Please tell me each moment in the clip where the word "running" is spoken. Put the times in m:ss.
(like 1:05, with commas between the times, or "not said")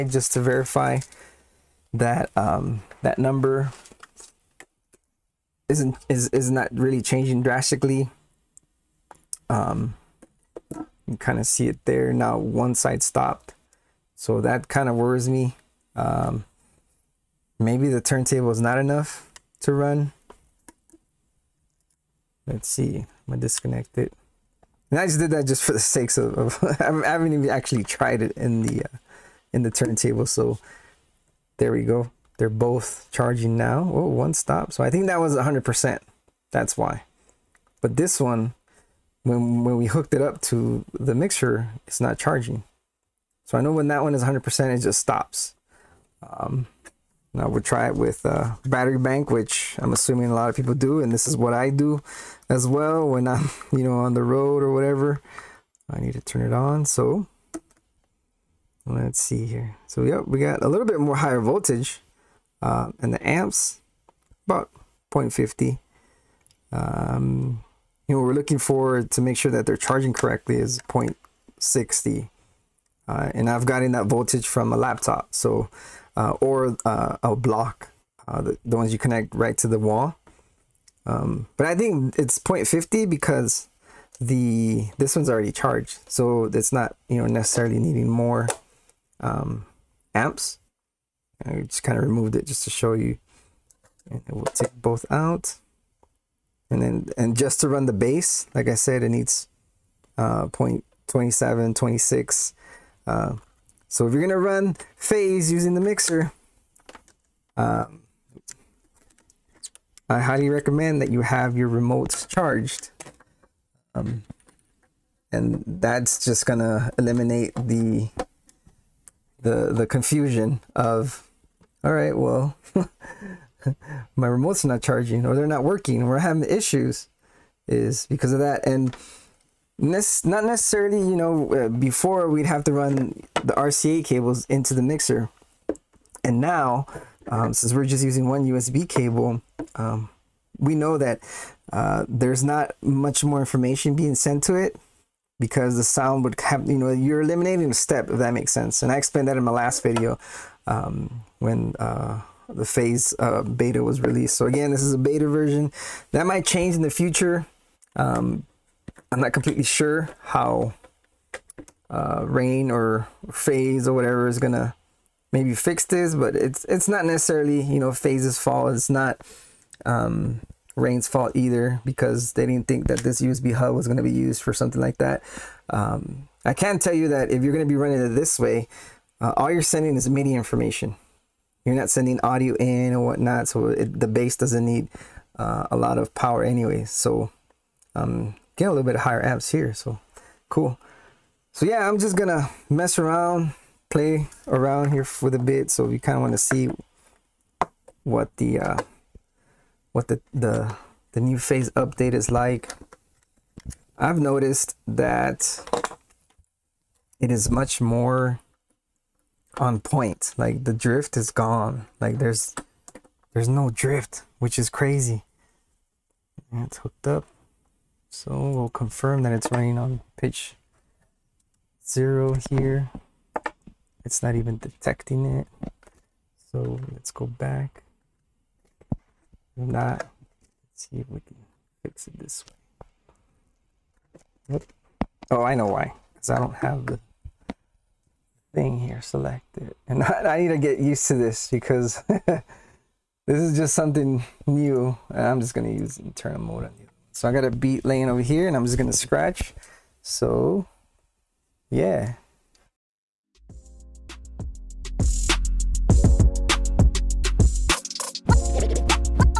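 2:57, 3:39.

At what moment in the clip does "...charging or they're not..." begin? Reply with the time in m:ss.
2:04.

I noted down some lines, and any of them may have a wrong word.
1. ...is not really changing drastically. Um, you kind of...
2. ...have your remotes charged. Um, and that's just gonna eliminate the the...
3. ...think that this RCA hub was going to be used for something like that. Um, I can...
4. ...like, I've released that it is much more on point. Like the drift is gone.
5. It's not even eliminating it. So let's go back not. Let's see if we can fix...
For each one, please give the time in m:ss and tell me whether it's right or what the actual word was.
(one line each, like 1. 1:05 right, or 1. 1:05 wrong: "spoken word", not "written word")
1. 0:06 right
2. 1:51 right
3. 2:52 wrong: "USB", not "RCA"
4. 3:22 wrong: "noticed", not "released"
5. 3:44 wrong: "detecting", not "eliminating".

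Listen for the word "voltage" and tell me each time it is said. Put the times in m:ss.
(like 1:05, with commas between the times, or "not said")
1:01, 1:14.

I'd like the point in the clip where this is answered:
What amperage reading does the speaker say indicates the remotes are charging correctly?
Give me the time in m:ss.
1:10.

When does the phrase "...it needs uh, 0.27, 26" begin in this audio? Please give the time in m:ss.
1:39.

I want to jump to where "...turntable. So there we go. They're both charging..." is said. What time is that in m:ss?
0:29.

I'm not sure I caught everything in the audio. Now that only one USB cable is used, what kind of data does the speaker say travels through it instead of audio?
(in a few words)
MIDI information.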